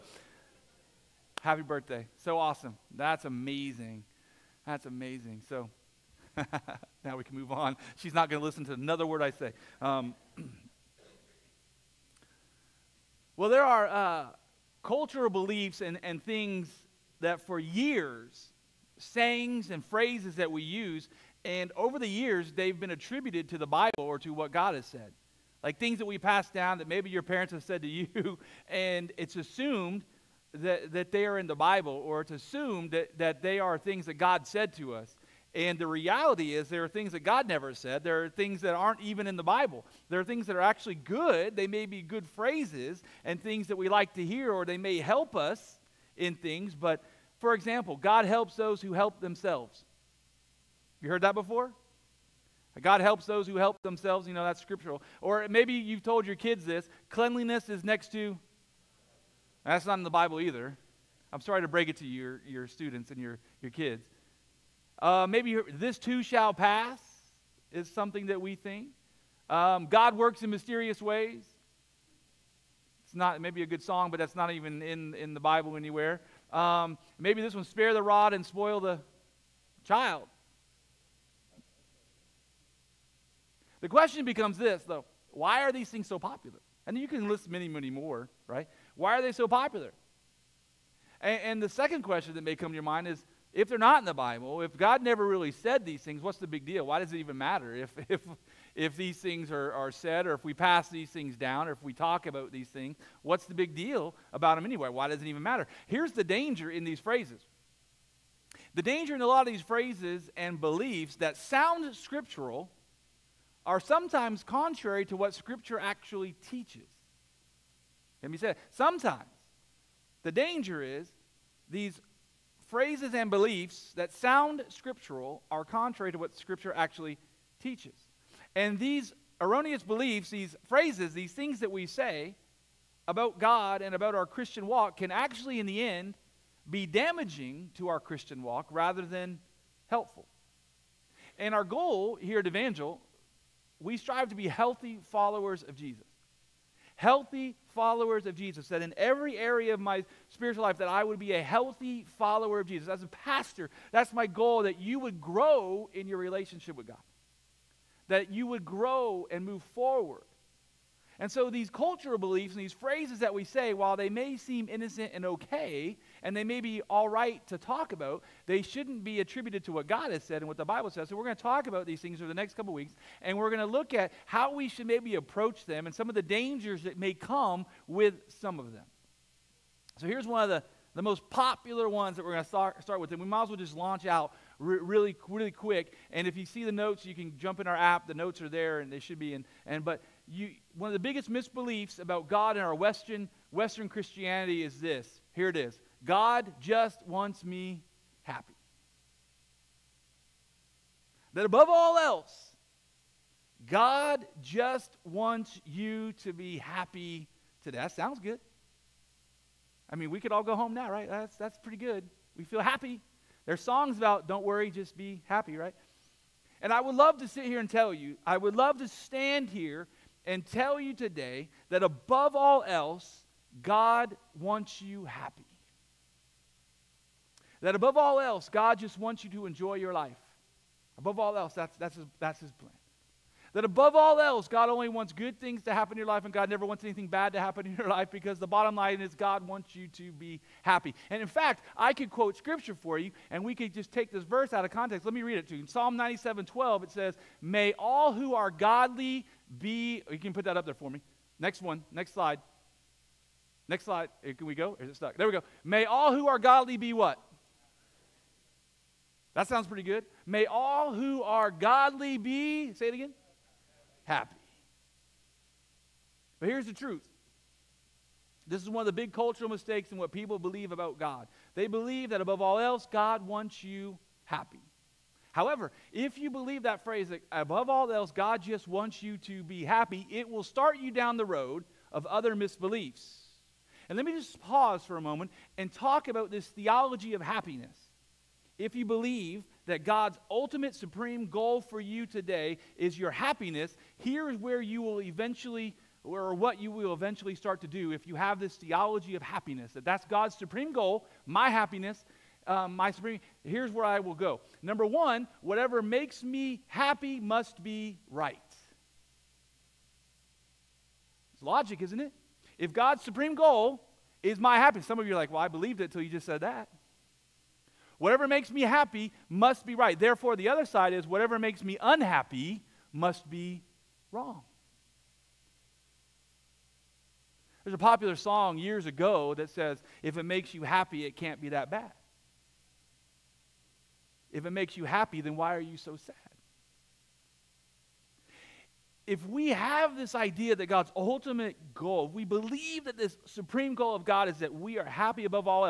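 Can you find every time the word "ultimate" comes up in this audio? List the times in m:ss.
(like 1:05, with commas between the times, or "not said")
4:50, 5:40.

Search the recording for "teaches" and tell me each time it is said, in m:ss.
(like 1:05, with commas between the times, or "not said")
1:56, 2:07.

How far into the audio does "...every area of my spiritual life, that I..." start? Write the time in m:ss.
2:28.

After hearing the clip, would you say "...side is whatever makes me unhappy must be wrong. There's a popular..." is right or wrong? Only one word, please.
right.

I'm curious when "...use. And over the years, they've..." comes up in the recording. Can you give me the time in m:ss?
0:20.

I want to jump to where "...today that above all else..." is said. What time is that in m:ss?
3:40.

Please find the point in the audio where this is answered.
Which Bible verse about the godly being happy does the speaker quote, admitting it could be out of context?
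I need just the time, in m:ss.
4:05.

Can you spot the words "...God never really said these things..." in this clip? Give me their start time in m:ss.
1:34.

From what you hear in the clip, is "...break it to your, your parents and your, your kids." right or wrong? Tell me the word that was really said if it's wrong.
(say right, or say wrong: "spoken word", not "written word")
wrong: "students", not "parents".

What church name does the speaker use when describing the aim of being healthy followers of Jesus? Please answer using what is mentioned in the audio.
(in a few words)
Evangel.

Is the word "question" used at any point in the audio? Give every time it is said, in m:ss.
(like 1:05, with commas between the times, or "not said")
1:23, 1:32.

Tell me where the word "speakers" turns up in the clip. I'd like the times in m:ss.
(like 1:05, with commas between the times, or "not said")
not said.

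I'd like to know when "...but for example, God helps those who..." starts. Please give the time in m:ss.
0:46.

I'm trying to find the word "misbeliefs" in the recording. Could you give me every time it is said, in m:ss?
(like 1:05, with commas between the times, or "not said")
3:11, 4:42.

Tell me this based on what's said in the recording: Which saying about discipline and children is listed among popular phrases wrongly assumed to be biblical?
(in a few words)
spare the rod and spoil the child.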